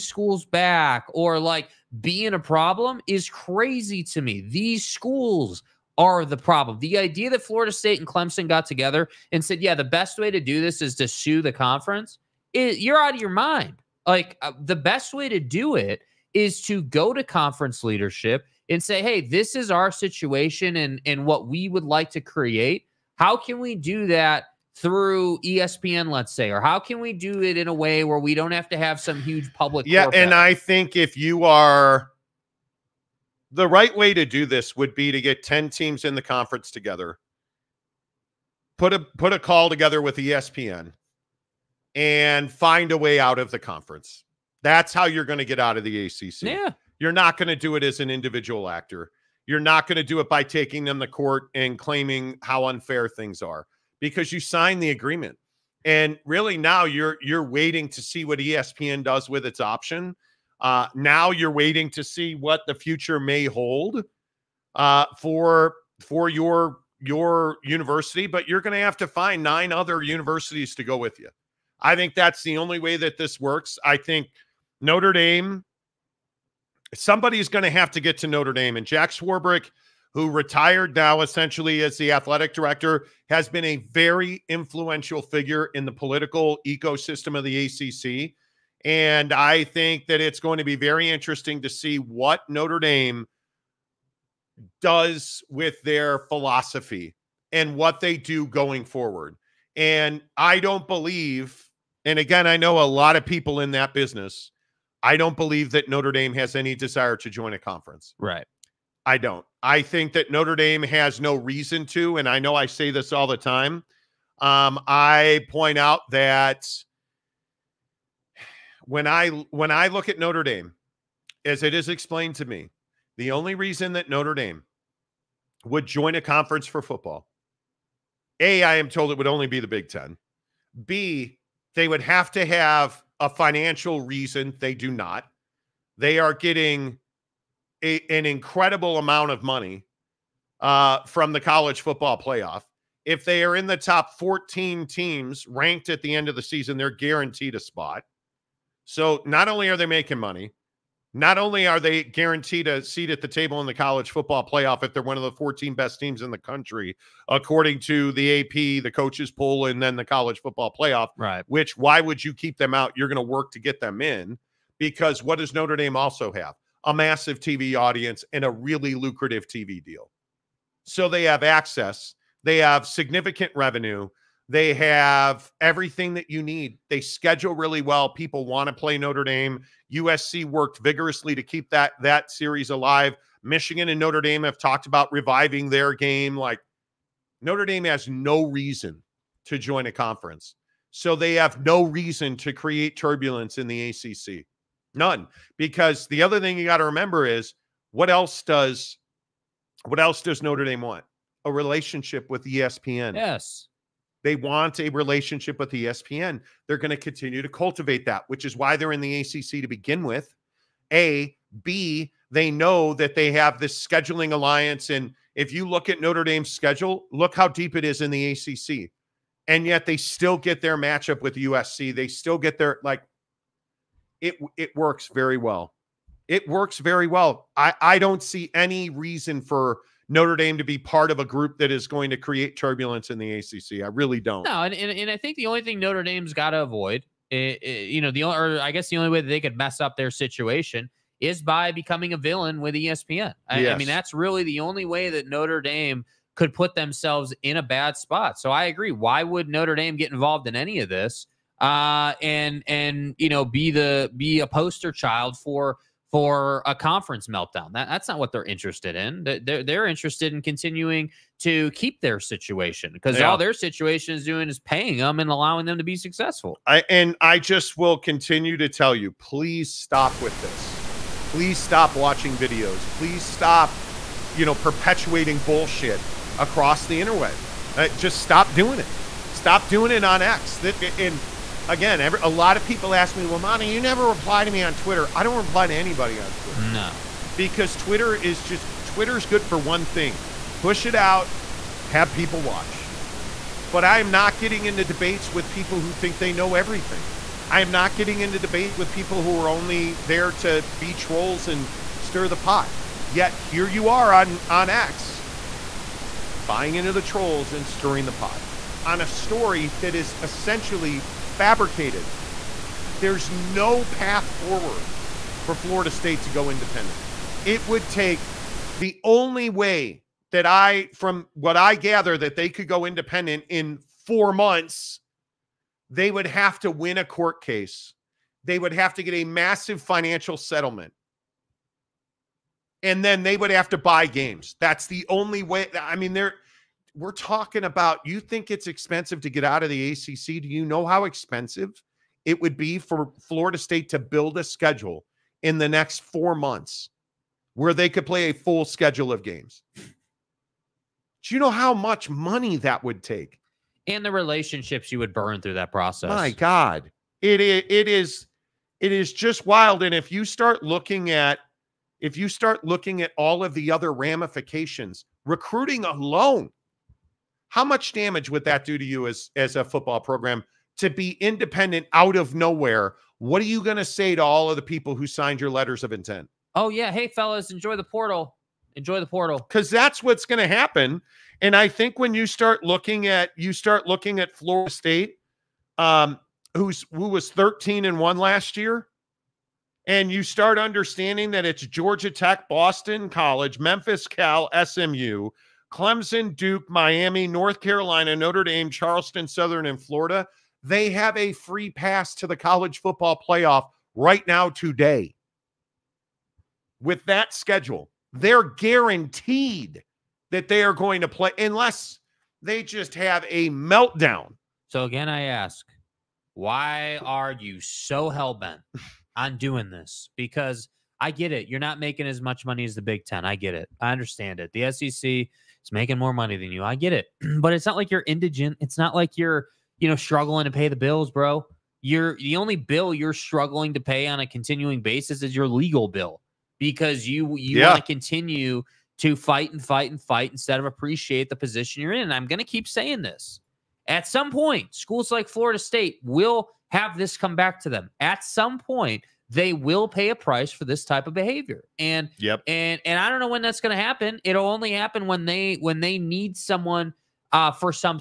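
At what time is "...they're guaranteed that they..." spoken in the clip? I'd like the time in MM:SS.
06:48.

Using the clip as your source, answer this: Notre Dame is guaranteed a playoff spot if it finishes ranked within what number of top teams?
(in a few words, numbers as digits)
14.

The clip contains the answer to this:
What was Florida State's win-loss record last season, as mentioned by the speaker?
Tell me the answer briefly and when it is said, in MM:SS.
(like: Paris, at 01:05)
13-1, at 06:27.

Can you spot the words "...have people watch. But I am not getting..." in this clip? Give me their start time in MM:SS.
04:51.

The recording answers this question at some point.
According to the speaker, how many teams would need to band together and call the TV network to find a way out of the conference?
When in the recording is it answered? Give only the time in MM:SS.
00:35.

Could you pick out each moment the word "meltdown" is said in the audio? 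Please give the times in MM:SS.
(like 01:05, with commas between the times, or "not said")
04:17, 06:53.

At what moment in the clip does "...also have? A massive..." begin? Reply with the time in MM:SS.
02:45.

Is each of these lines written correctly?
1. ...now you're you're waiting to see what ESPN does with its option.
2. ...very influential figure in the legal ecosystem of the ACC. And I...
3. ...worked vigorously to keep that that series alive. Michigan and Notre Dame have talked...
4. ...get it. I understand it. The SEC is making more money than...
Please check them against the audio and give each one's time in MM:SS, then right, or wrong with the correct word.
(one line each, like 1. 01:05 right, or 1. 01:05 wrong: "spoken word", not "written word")
1. 00:56 right
2. 01:23 wrong: "political", not "legal"
3. 03:00 right
4. 07:03 right.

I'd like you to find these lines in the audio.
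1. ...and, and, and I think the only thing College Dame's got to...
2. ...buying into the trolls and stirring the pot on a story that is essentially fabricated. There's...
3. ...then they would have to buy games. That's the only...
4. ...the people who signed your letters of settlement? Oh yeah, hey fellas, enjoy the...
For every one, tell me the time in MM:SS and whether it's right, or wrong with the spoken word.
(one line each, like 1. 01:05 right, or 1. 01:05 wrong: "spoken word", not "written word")
1. 03:54 wrong: "Notre", not "College"
2. 05:06 right
3. 05:33 right
4. 06:14 wrong: "intent", not "settlement".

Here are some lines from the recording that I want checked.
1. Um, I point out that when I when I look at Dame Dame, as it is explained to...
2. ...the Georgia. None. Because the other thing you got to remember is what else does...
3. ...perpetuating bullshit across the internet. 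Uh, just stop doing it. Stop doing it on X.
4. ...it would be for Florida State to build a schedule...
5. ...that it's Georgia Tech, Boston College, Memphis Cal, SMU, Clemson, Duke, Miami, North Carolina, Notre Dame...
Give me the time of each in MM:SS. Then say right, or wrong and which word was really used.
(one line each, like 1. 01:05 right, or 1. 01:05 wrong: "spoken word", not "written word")
1. 01:54 wrong: "Notre", not "Dame"
2. 03:13 wrong: "ACC", not "Georgia"
3. 04:34 right
4. 05:42 right
5. 06:31 right.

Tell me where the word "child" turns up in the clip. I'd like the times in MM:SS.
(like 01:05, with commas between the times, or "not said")
04:14.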